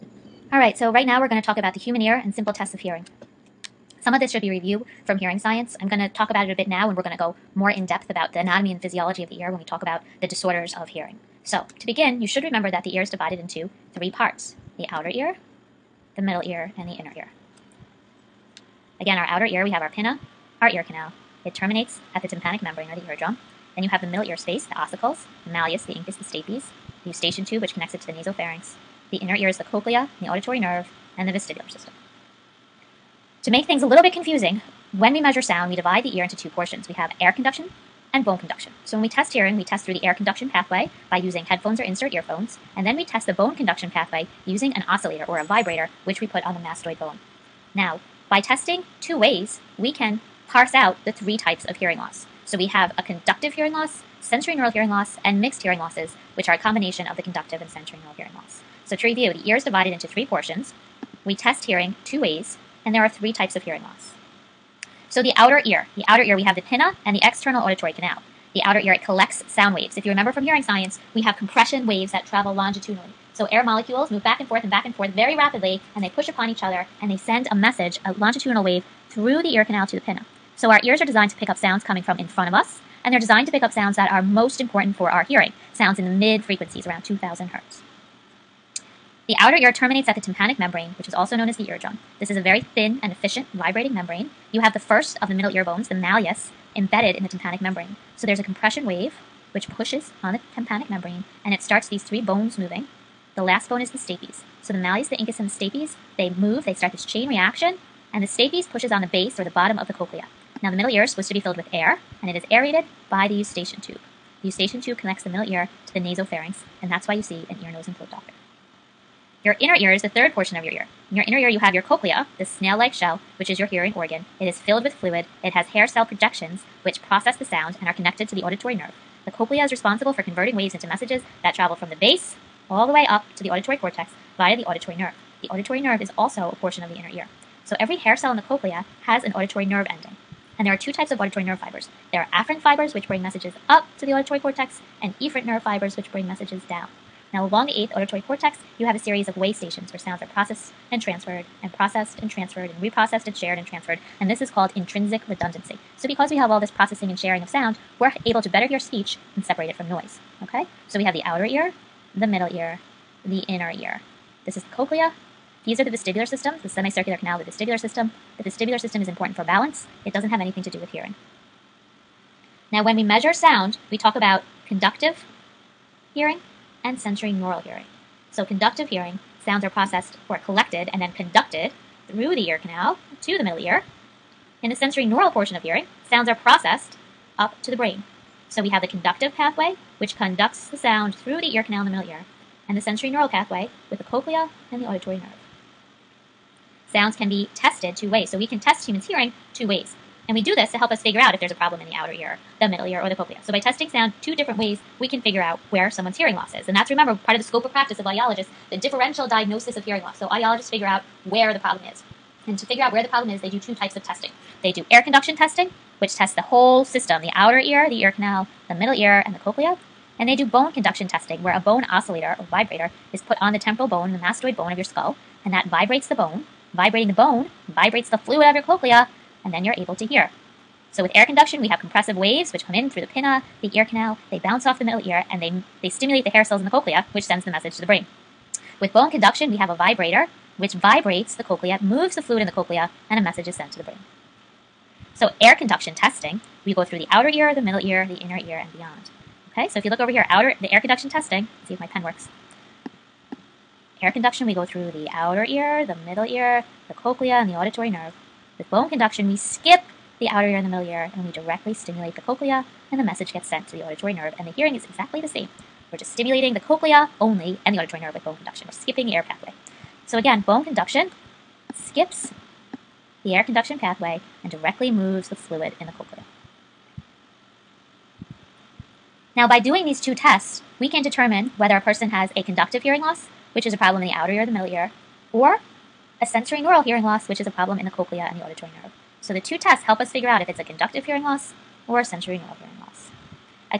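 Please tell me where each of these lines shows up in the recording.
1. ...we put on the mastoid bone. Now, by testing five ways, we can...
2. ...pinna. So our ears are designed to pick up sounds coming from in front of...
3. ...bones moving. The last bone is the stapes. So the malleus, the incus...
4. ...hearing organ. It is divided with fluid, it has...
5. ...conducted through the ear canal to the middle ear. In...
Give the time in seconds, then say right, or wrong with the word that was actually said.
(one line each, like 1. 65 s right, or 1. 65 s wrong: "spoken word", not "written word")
1. 46 s wrong: "two", not "five"
2. 80 s right
3. 102 s right
4. 123 s wrong: "filled", not "divided"
5. 181 s right.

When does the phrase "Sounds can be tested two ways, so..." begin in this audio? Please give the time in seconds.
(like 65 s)
196 s.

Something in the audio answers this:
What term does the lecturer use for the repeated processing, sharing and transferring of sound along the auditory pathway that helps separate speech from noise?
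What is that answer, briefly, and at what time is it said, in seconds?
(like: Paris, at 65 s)
intrinsic redundancy, at 154 s.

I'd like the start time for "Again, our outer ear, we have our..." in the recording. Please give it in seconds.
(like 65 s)
18 s.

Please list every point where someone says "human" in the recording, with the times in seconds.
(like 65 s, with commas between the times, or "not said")
1 s, 198 s.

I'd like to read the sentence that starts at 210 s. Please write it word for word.
So audiologists figure out where the problem is.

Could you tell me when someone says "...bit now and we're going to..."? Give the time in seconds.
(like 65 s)
6 s.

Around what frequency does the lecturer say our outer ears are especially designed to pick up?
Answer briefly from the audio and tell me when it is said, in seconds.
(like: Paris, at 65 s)
2000 hertz, at 87 s.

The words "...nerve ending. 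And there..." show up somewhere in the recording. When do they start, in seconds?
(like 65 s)
139 s.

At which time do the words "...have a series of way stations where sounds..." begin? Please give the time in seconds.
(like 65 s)
148 s.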